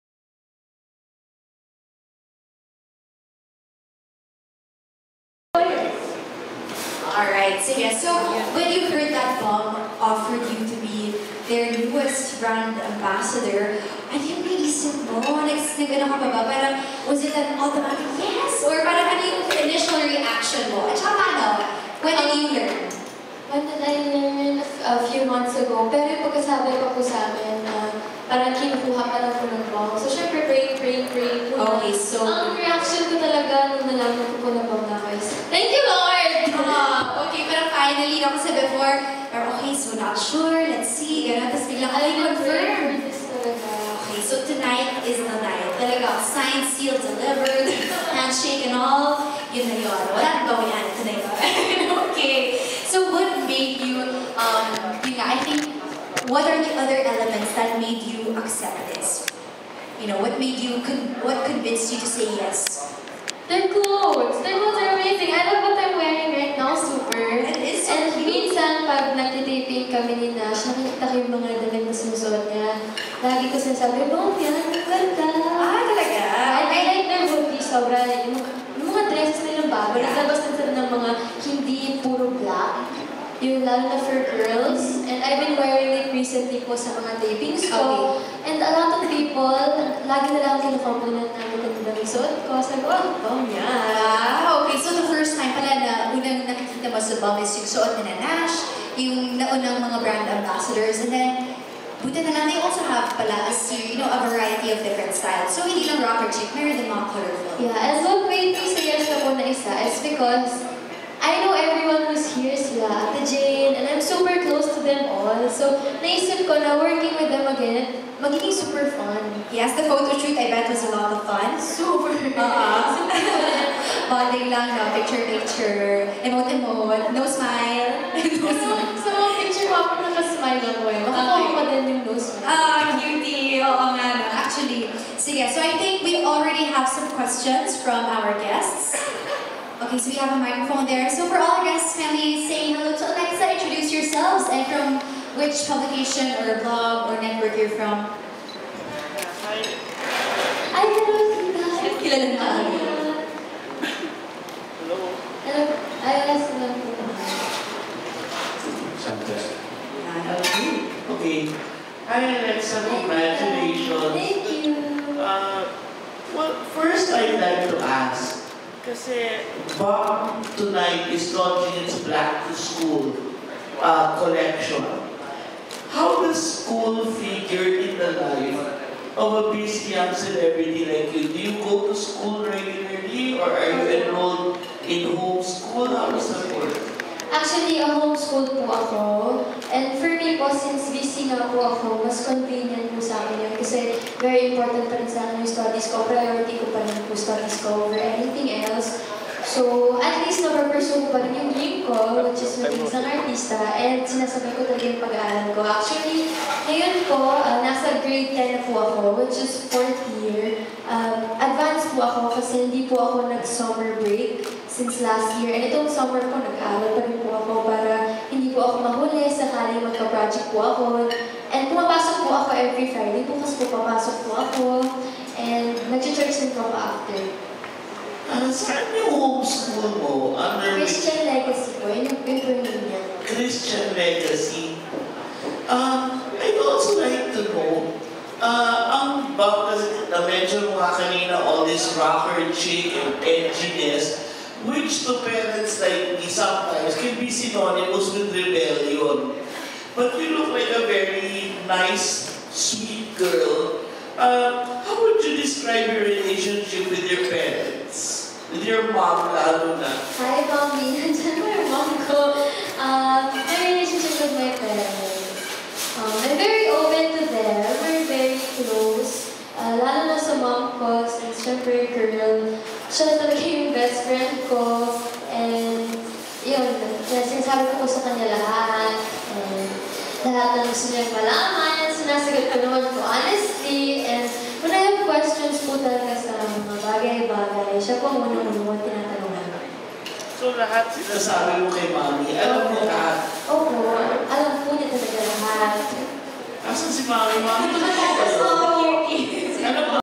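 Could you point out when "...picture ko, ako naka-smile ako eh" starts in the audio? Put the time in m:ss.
2:09.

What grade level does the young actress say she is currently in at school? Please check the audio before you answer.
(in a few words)
Grade 10.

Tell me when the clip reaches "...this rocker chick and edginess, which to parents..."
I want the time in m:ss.
4:01.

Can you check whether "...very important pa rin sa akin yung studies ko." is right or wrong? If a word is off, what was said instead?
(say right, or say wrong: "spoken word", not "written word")
right.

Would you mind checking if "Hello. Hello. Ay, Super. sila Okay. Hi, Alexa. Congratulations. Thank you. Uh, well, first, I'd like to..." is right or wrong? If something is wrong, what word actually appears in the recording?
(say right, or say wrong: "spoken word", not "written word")
wrong: "Hello", not "Super".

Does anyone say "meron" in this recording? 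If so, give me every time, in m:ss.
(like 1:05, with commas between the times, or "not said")
1:46, 2:30.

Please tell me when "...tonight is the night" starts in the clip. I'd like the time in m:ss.
0:44.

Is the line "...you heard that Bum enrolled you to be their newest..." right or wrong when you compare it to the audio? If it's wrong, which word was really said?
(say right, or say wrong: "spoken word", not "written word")
wrong: "offered", not "enrolled".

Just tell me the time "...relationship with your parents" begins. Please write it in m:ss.
4:16.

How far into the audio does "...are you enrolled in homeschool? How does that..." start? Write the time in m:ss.
3:03.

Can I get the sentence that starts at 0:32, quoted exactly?
Ang reaction ko talaga nung nalaman ko po na Bum na is, Thank you, Lord!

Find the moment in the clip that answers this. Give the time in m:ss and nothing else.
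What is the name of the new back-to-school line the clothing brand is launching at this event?
2:52.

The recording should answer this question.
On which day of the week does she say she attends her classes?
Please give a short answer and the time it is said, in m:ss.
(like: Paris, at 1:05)
Friday, at 3:42.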